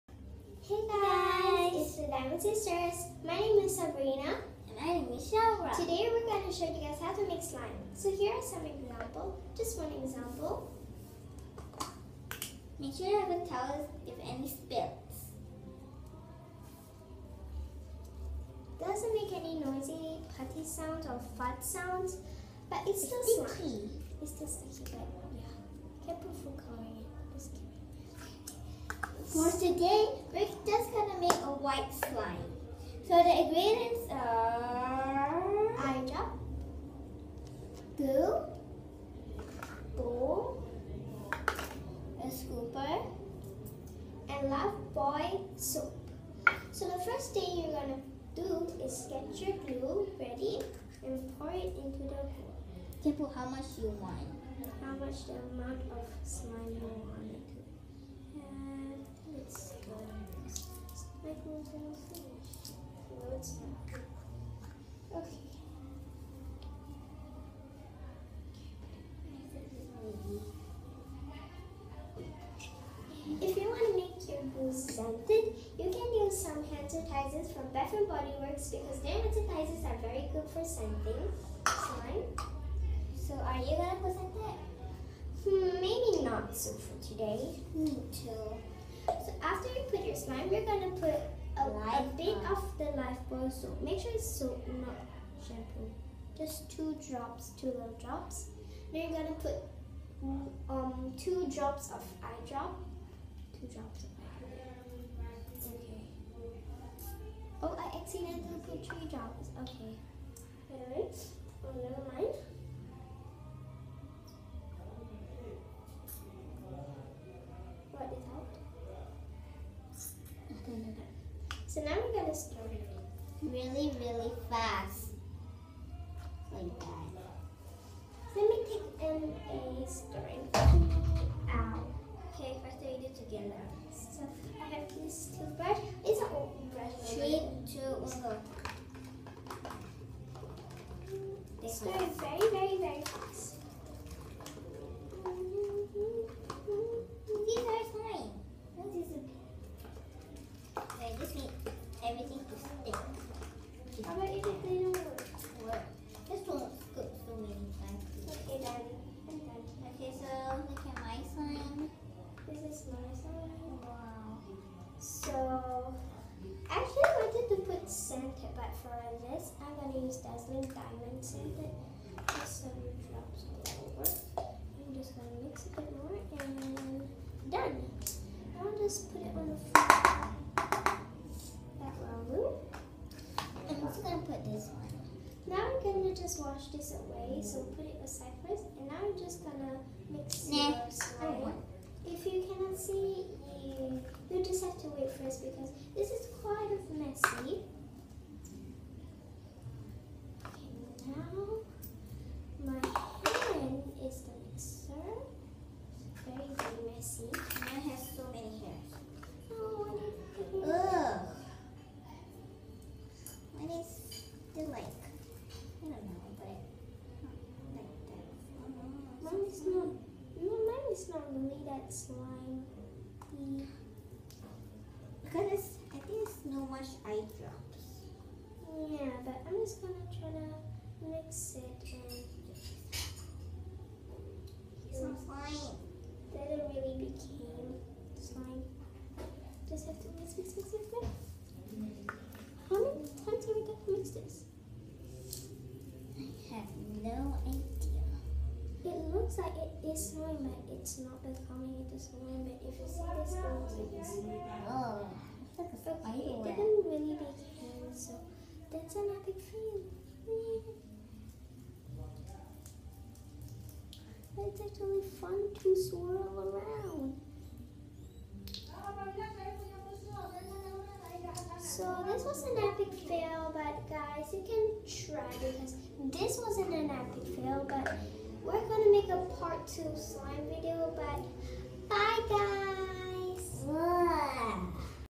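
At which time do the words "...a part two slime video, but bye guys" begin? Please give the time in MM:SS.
04:39.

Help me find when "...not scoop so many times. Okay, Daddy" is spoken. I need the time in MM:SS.
02:36.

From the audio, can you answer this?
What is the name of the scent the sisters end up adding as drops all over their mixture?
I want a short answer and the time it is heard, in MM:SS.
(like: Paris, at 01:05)
Dazzling Diamond, at 02:50.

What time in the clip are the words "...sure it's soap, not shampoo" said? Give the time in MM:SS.
01:33.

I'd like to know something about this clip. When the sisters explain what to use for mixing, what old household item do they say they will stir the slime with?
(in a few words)
Toothbrush.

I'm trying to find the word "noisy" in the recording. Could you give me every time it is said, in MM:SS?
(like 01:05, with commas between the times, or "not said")
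00:19.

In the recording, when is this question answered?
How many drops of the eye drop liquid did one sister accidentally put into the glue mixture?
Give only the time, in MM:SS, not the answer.
01:48.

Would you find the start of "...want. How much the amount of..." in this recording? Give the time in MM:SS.
00:54.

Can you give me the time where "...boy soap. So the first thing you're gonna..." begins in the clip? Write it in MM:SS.
00:44.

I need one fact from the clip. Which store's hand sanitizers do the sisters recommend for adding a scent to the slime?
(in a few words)
Bath and Body Works.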